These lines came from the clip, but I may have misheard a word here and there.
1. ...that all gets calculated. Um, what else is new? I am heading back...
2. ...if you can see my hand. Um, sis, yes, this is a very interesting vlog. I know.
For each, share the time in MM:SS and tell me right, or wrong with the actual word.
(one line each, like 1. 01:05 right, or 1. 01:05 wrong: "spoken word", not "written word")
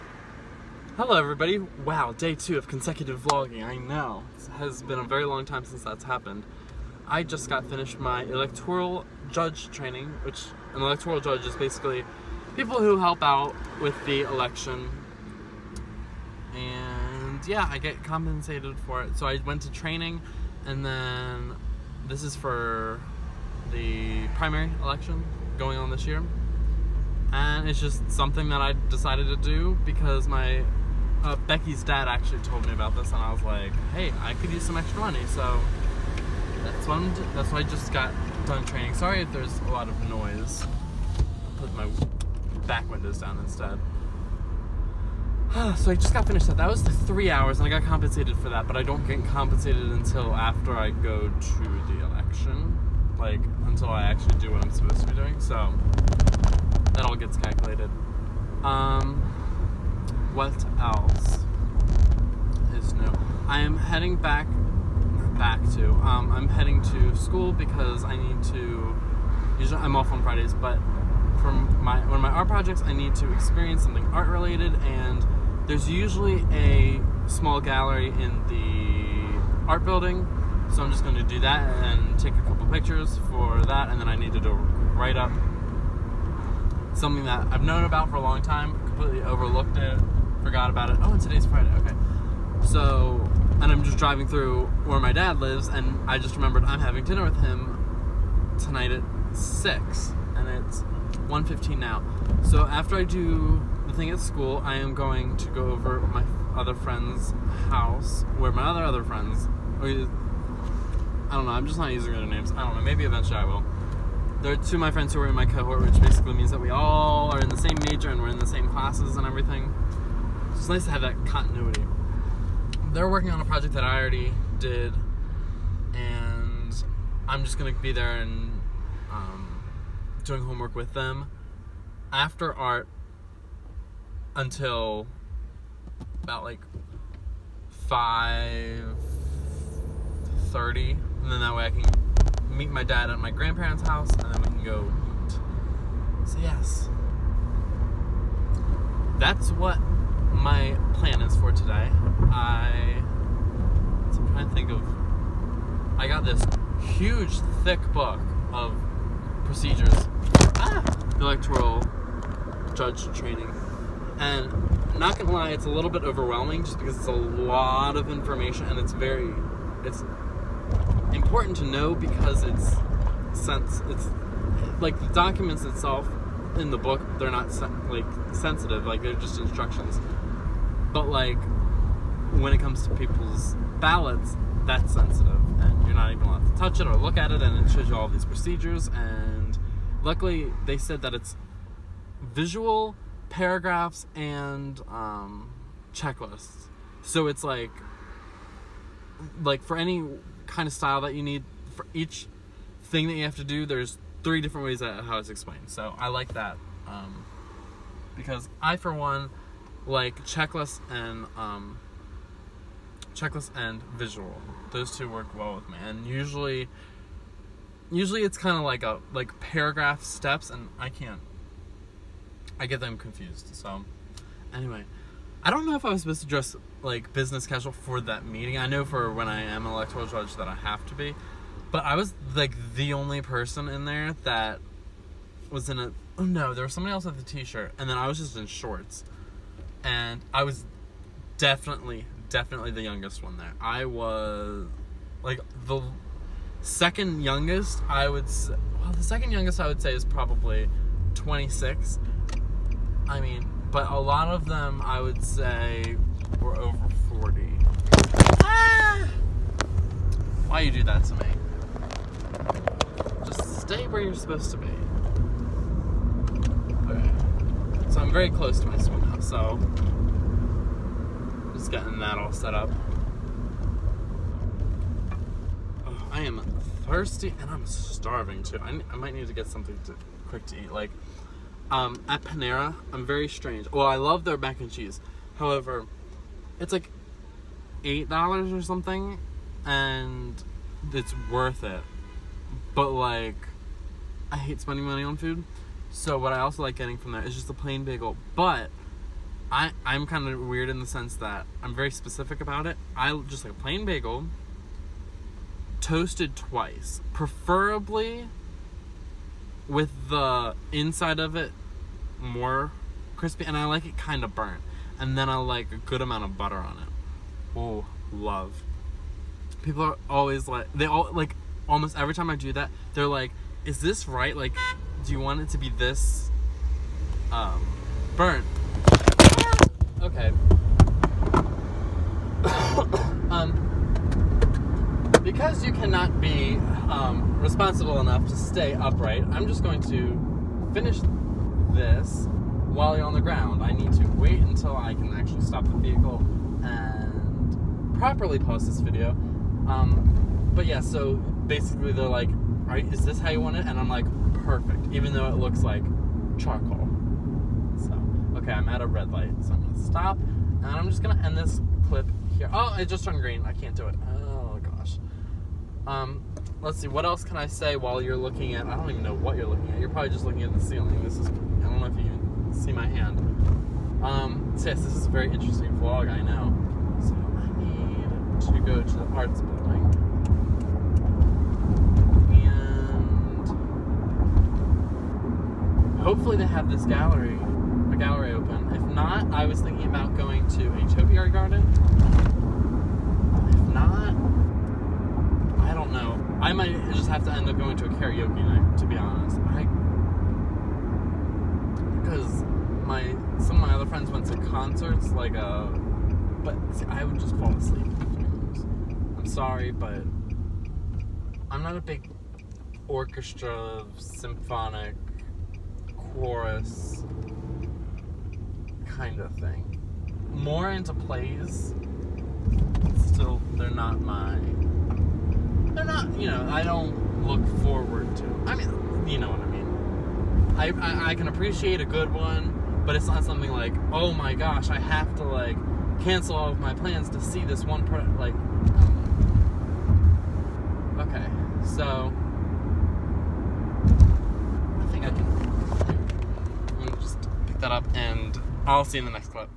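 1. 00:56 right
2. 06:11 right.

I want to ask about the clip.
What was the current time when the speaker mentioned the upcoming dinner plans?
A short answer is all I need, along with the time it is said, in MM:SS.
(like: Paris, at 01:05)
1:15, at 01:41.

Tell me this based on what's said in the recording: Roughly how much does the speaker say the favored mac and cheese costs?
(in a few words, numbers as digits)
$8.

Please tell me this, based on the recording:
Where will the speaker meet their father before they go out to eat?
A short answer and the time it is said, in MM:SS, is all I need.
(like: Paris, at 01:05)
grandparents' house, at 02:23.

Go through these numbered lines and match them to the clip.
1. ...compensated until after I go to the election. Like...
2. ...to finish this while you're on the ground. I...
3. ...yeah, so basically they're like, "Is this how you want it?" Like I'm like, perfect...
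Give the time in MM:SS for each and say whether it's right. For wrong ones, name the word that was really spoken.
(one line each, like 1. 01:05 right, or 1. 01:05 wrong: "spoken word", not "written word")
1. 00:49 right
2. 05:39 right
3. 05:50 wrong: "And", not "Like".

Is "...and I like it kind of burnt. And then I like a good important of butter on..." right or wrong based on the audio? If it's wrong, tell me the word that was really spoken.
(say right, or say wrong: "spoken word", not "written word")
wrong: "amount", not "important".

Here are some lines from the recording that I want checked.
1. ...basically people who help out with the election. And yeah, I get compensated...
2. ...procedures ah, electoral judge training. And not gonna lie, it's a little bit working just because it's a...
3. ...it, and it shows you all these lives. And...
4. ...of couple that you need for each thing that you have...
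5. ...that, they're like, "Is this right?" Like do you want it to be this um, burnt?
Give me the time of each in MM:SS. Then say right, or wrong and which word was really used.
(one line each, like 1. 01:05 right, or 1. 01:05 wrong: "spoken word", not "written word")
1. 00:11 right
2. 02:39 wrong: "overwhelming", not "working"
3. 03:07 wrong: "procedures", not "lives"
4. 03:20 wrong: "style", not "couple"
5. 05:22 right.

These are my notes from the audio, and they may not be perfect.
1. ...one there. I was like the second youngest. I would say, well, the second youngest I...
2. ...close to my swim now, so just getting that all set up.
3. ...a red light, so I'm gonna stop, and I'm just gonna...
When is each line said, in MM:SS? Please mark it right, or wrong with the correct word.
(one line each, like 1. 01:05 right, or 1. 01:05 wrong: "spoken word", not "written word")
1. 04:03 right
2. 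04:28 right
3. 05:58 right.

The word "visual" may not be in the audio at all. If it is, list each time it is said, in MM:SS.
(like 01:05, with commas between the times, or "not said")
03:12, 03:33.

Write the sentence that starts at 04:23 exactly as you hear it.
Just stay where you're supposed to be.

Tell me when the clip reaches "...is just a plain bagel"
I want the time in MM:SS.
04:57.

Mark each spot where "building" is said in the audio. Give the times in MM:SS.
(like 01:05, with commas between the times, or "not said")
01:19, 06:19.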